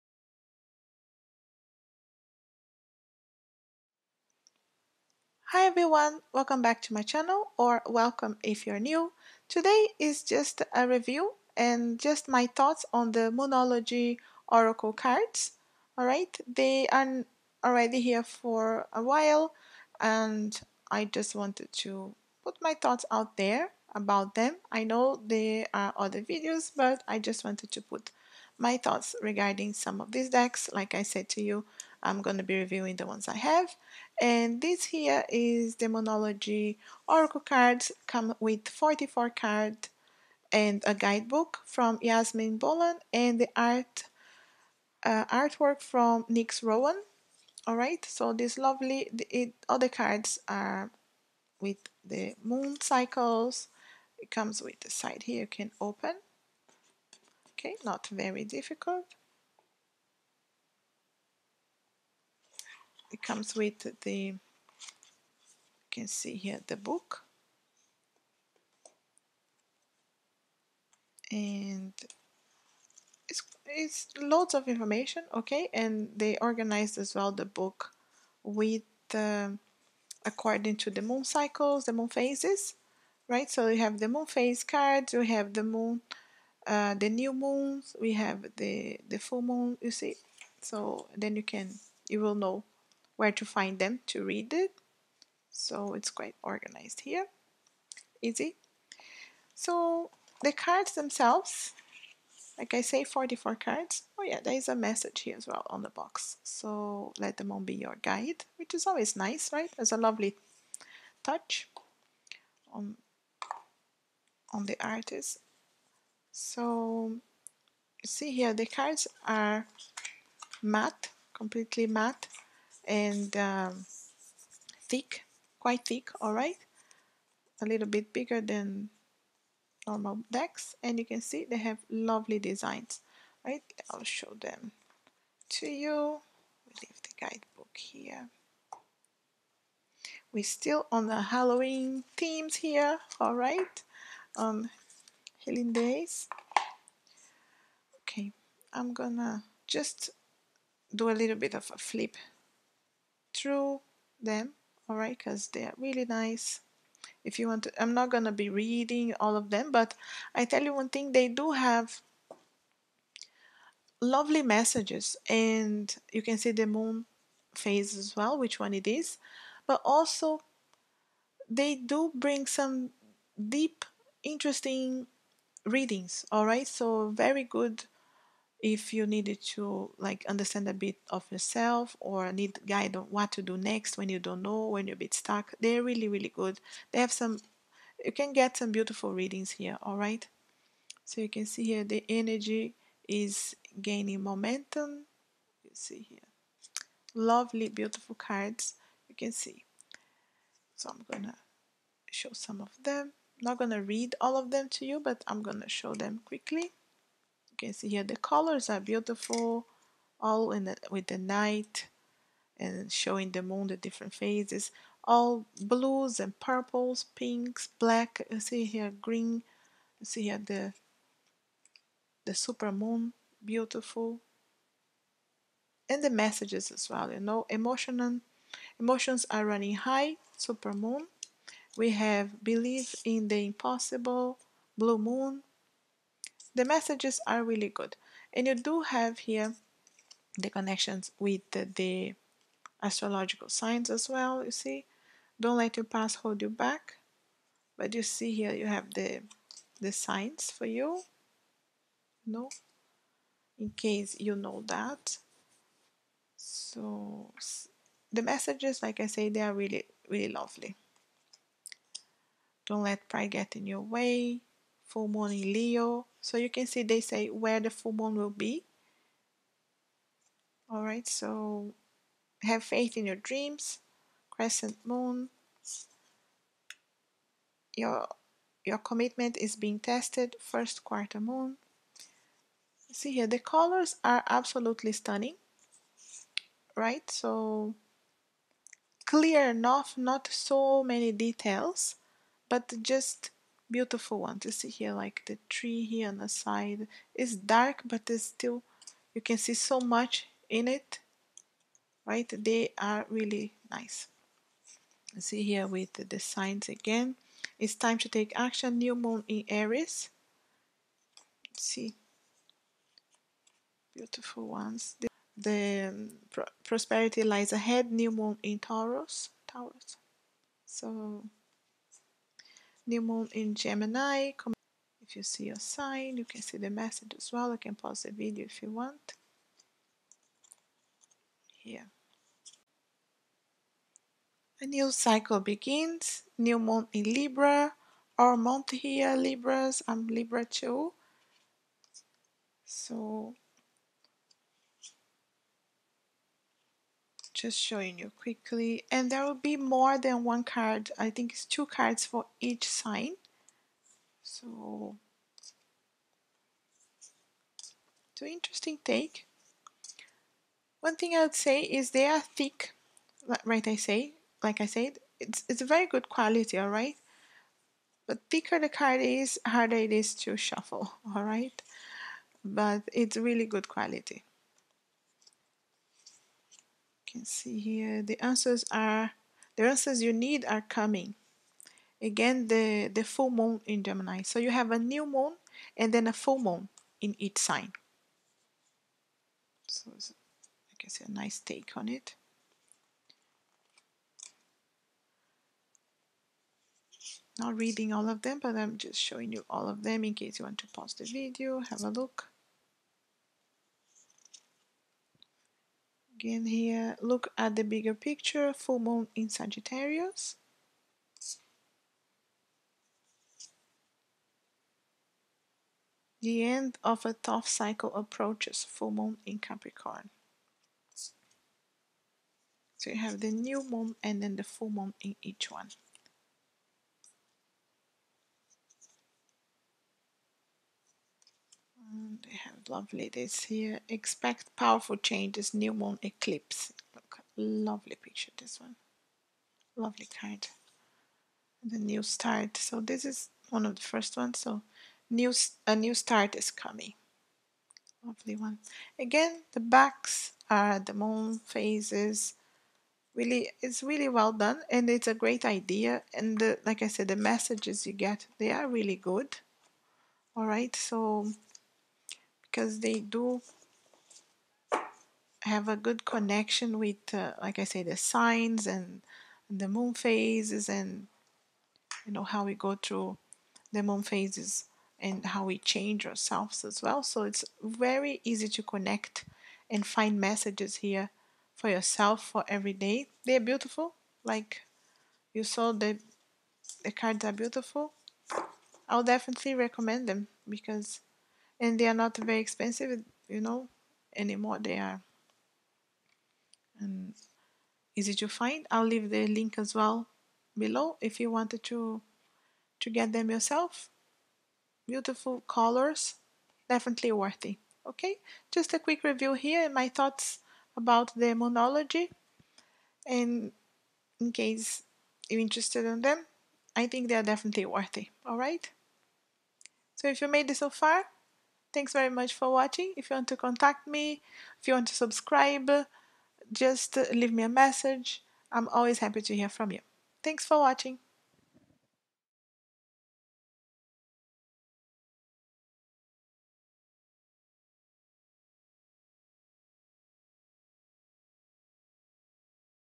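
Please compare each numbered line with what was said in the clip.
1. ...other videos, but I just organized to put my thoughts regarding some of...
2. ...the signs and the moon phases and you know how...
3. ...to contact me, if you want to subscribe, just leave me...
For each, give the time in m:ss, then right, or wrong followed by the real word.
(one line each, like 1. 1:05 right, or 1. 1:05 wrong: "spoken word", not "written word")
1. 0:25 wrong: "wanted", not "organized"
2. 7:47 right
3. 8:43 right.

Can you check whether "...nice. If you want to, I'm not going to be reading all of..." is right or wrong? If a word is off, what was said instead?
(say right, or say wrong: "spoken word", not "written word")
right.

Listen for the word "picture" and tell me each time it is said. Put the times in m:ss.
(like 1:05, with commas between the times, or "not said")
6:47, 7:18.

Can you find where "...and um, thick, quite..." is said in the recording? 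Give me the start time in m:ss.
2:02.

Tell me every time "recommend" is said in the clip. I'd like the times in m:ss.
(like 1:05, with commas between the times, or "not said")
8:09.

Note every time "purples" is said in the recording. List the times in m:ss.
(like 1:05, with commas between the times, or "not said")
3:36.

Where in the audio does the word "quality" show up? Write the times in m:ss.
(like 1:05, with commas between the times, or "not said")
6:06, 6:13.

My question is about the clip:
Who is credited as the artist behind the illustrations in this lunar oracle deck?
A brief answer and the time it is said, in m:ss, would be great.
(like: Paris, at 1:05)
Nix Rowan, at 0:46.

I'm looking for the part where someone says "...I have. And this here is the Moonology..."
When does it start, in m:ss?
0:33.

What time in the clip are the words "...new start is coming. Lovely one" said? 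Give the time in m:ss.
7:25.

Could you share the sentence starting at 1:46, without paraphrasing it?
So let them all be your guide, which is always nice, right?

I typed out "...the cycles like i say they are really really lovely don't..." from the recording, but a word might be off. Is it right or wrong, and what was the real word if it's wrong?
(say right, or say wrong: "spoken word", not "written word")
wrong: "messages", not "cycles".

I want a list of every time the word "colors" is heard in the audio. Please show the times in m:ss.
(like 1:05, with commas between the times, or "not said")
3:28, 4:43, 8:25.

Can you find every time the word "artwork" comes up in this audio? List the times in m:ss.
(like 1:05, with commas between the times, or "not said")
0:45.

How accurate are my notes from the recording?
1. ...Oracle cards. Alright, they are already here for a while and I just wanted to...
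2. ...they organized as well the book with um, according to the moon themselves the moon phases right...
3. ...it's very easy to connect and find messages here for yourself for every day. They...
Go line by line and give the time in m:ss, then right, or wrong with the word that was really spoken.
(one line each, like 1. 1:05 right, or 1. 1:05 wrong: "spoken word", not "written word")
1. 0:14 right
2. 1:16 wrong: "cycles", not "themselves"
3. 7:57 right.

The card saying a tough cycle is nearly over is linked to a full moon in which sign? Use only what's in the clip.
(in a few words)
Capricorn.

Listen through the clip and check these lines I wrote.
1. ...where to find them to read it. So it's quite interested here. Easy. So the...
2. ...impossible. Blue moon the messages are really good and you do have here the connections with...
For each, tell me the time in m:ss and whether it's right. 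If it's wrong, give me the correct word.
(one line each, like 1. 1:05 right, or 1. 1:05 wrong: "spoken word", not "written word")
1. 1:33 wrong: "organized", not "interested"
2. 3:53 right.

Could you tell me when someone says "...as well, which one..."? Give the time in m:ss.
2:47.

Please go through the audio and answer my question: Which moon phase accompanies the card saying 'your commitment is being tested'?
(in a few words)
First quarter moon.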